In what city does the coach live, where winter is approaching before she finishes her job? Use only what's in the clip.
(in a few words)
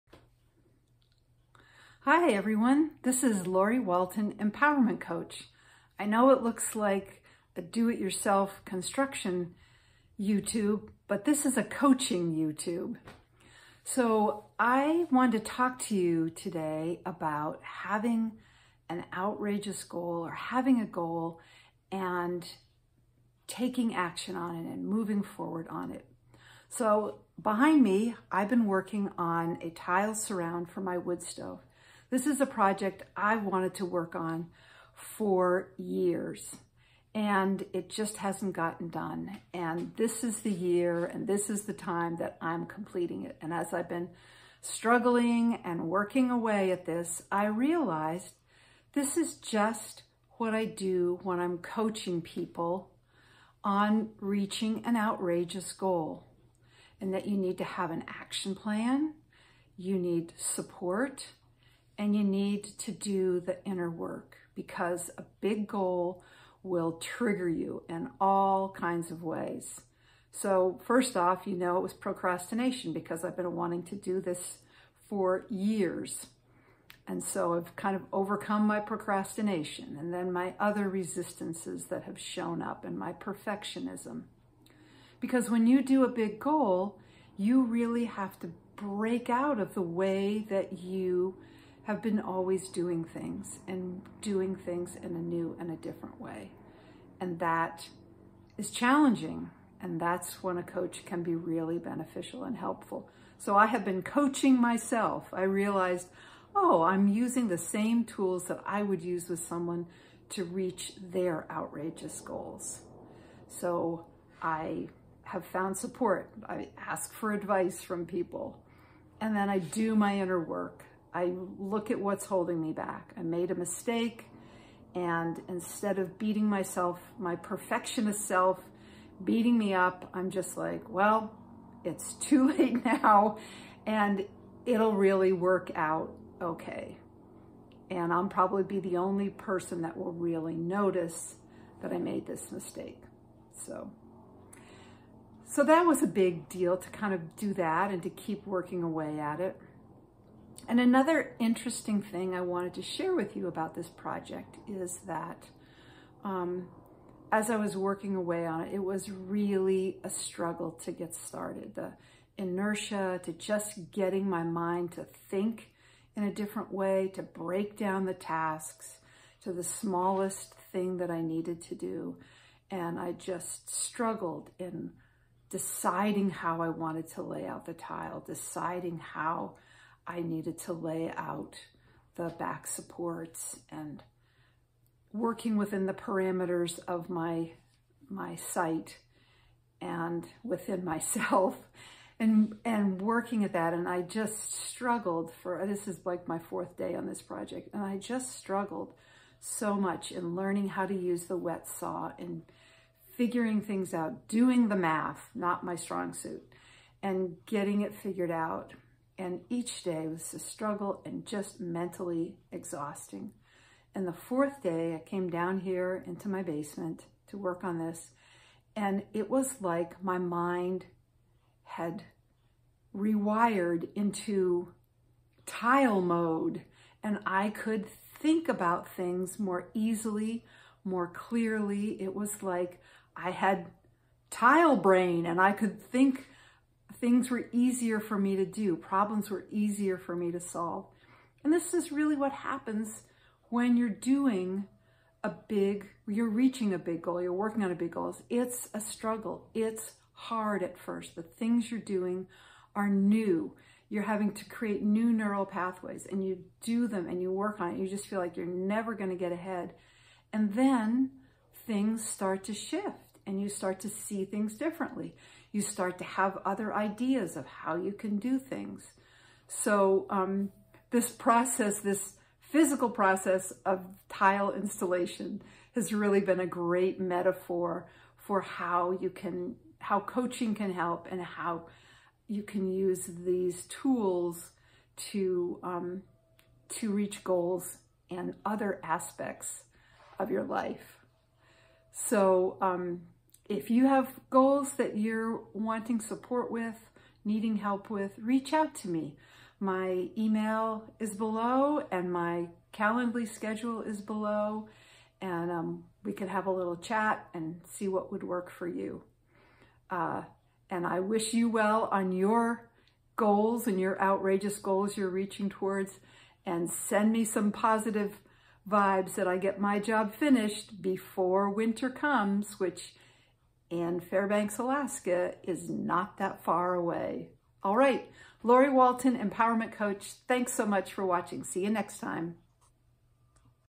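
Fairbanks, Alaska.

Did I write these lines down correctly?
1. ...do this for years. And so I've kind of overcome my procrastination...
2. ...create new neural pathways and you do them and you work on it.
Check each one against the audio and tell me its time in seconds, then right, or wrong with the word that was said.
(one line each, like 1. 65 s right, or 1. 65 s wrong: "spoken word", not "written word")
1. 73 s right
2. 254 s right.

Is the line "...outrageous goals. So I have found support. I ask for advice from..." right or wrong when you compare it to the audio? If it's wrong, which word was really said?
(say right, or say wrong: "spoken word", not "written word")
right.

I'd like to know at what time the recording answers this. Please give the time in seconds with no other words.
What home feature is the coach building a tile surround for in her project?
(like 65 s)
30 s.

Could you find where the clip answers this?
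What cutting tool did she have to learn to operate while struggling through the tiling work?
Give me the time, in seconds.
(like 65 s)
201 s.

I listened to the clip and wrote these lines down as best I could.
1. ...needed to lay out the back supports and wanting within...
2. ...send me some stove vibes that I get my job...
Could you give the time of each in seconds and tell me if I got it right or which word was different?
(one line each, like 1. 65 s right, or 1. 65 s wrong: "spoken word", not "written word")
1. 180 s wrong: "working", not "wanting"
2. 316 s wrong: "positive", not "stove".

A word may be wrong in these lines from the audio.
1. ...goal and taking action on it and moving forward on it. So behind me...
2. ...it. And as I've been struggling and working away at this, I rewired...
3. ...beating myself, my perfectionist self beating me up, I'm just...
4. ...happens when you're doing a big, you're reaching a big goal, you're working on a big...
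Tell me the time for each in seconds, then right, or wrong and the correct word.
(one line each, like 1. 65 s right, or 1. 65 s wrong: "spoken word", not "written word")
1. 20 s right
2. 43 s wrong: "realized", not "rewired"
3. 126 s right
4. 242 s right.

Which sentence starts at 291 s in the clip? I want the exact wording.
So, um, if you have goals that you're wanting support with, needing help with, reach out to me.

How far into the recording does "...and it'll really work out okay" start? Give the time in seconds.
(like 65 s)
133 s.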